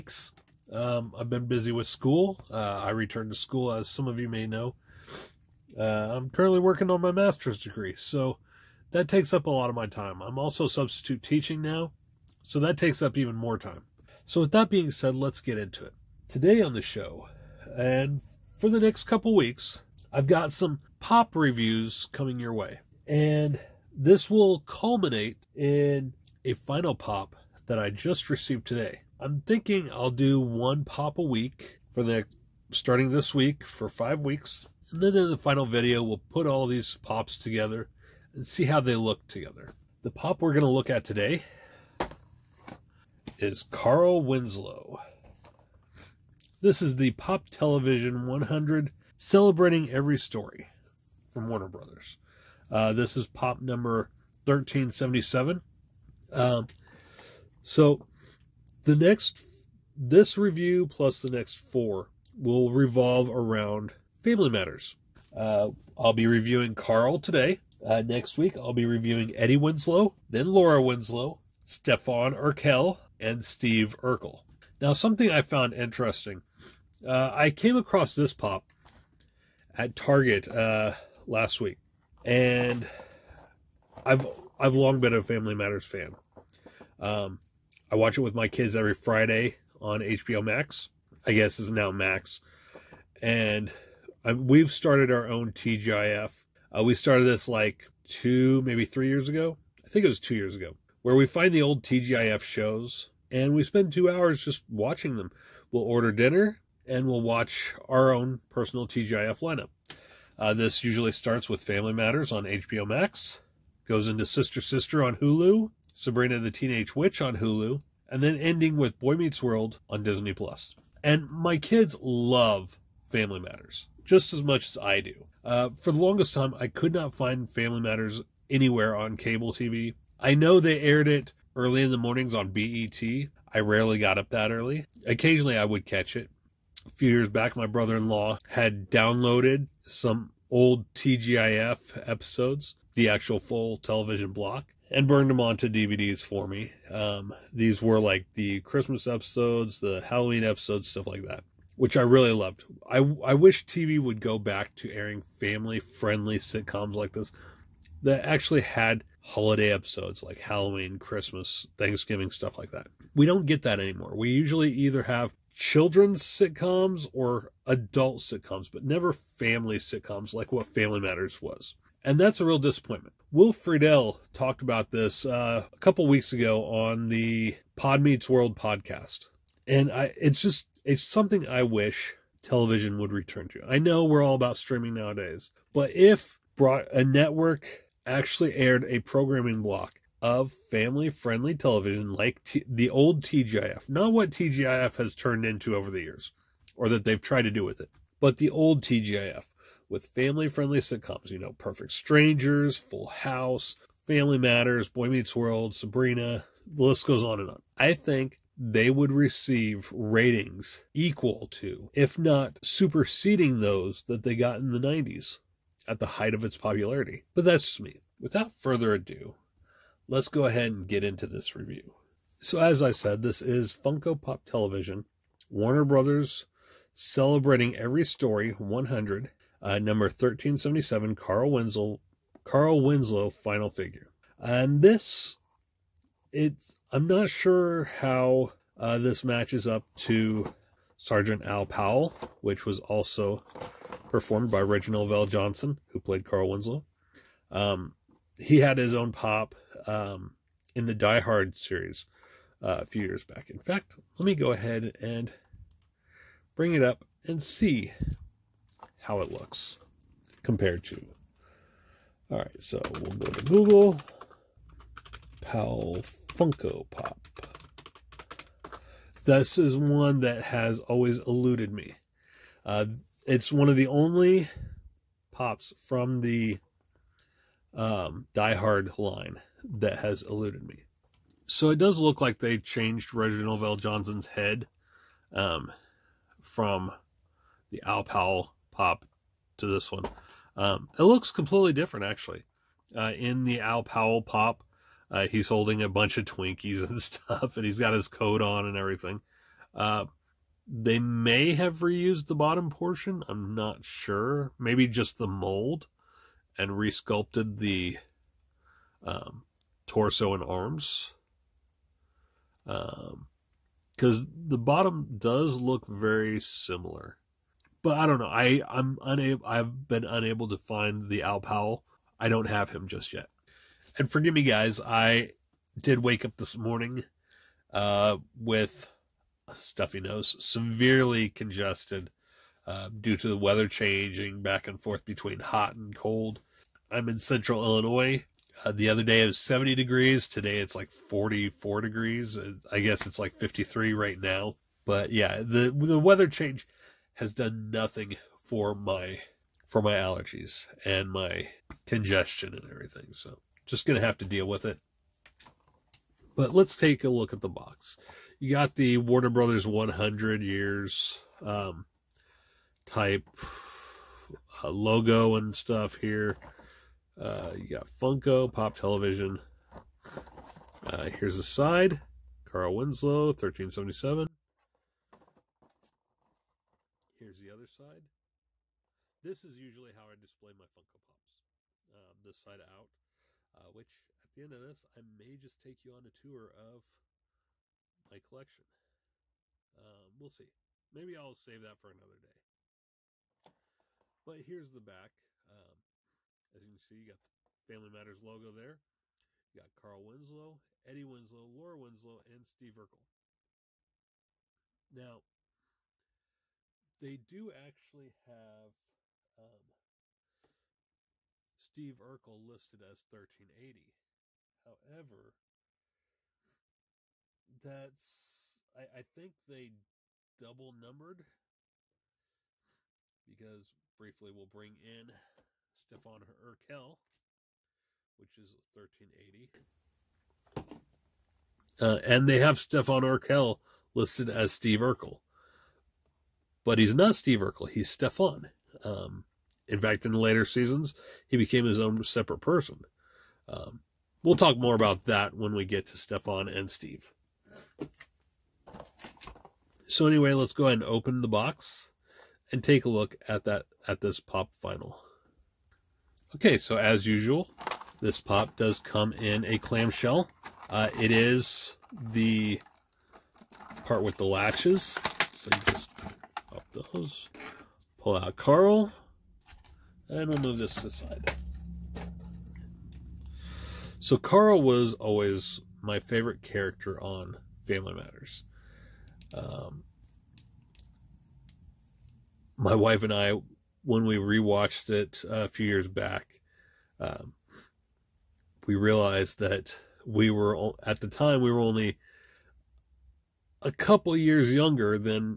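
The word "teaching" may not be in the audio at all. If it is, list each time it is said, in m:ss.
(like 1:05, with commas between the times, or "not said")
0:11.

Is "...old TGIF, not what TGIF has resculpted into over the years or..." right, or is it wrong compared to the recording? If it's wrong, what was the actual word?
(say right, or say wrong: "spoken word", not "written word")
wrong: "turned", not "resculpted".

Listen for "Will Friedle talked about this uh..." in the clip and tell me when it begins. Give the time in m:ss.
2:53.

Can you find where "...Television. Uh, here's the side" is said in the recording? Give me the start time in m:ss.
6:08.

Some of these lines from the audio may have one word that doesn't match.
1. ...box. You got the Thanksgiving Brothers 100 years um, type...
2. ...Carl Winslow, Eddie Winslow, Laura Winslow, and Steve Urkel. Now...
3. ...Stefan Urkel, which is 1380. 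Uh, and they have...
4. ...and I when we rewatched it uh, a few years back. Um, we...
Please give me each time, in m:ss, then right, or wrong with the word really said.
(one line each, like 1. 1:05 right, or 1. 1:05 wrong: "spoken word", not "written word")
1. 5:57 wrong: "Warner", not "Thanksgiving"
2. 6:39 right
3. 7:05 right
4. 8:03 right.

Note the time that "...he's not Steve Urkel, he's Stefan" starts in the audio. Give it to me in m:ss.
7:16.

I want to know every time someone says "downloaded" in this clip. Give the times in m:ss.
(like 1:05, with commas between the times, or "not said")
2:18.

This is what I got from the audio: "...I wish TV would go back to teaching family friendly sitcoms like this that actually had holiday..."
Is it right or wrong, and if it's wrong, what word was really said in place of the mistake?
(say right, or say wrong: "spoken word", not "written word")
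wrong: "airing", not "teaching".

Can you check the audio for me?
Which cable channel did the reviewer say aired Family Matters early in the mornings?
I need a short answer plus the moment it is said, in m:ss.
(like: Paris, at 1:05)
BET, at 2:12.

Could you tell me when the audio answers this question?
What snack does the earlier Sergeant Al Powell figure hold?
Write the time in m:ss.
4:56.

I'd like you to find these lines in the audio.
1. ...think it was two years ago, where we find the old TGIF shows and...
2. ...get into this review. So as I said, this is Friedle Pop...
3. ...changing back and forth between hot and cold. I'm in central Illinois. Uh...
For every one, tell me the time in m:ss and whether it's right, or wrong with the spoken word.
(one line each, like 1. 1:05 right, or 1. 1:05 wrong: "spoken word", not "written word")
1. 1:39 right
2. 3:40 wrong: "Funko", not "Friedle"
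3. 5:33 right.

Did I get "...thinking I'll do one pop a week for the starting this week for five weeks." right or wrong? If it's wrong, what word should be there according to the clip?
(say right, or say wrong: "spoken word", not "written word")
right.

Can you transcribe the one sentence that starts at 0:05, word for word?
Uh, I'm currently working on my master's degree, so that takes up a lot of my time.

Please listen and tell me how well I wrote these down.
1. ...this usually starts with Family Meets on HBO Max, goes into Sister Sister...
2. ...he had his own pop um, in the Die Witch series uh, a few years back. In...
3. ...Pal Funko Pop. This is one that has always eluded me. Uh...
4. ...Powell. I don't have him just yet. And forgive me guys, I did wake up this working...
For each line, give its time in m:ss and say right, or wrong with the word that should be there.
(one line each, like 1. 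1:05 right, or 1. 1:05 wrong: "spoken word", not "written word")
1. 1:50 wrong: "Matters", not "Meets"
2. 4:08 wrong: "Hard", not "Witch"
3. 4:25 right
4. 5:21 wrong: "morning", not "working".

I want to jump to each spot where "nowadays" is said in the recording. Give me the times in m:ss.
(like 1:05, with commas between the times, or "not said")
3:04.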